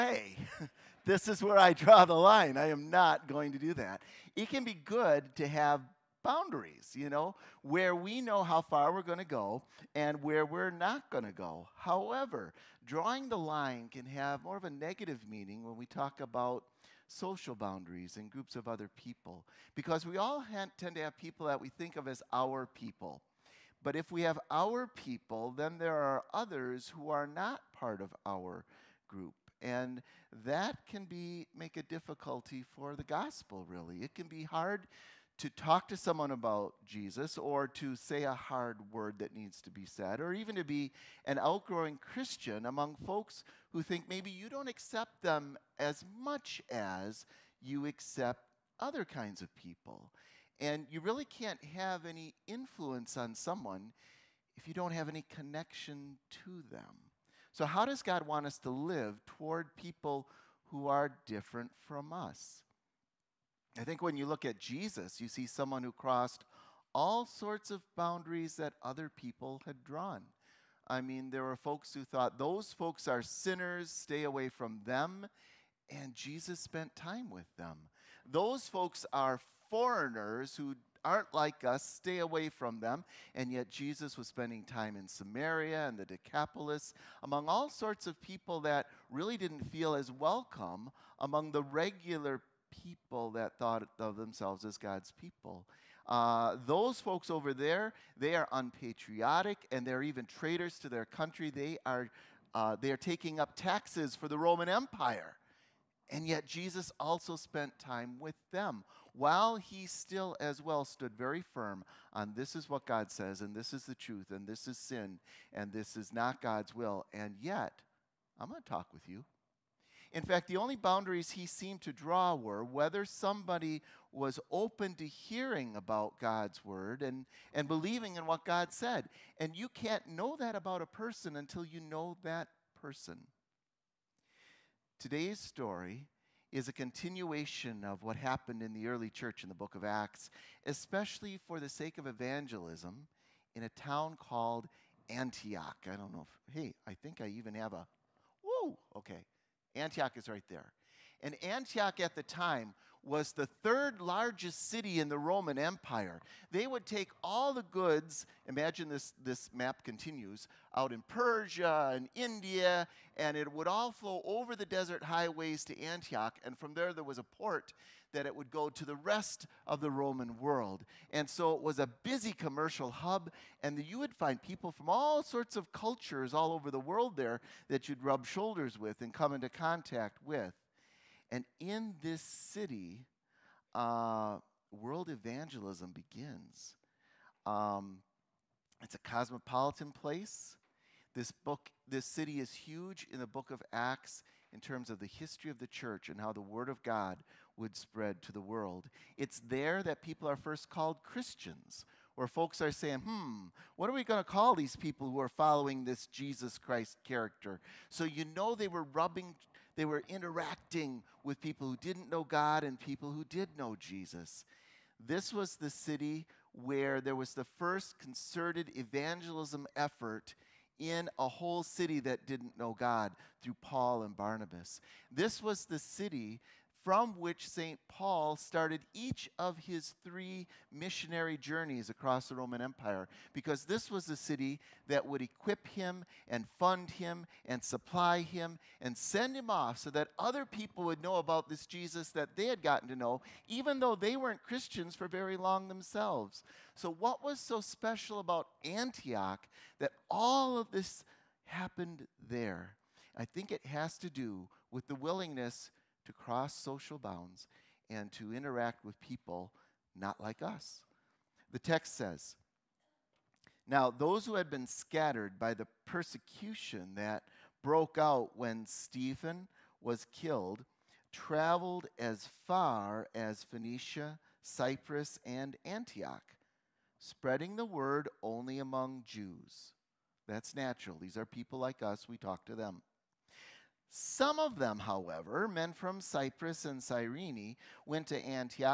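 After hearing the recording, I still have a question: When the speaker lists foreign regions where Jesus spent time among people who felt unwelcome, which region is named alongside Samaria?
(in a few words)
Decapolis.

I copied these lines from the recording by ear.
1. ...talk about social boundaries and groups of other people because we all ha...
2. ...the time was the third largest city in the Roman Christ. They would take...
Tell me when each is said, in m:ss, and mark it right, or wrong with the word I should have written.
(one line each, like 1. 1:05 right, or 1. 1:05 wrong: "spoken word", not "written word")
1. 0:15 right
2. 2:32 wrong: "Empire", not "Christ".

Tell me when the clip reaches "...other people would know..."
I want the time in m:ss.
4:00.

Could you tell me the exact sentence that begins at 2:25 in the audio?
I don't know if, hey, I think I even have a, whoa, okay.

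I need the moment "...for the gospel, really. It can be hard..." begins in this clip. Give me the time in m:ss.
0:32.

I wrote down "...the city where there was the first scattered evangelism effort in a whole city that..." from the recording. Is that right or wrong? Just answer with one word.
wrong.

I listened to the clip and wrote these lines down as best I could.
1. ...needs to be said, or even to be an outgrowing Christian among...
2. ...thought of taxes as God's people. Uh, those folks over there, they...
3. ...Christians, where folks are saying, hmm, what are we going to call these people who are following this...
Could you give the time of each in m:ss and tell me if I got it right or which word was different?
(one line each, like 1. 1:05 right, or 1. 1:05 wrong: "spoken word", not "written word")
1. 0:39 right
2. 1:33 wrong: "themselves", not "taxes"
3. 3:21 right.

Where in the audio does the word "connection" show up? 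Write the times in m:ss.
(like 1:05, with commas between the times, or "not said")
0:55.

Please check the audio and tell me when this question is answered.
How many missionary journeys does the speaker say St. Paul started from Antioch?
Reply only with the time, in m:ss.
3:50.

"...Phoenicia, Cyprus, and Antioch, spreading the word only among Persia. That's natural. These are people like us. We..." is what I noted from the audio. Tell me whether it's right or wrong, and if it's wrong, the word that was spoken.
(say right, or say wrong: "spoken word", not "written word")
wrong: "Jews", not "Persia".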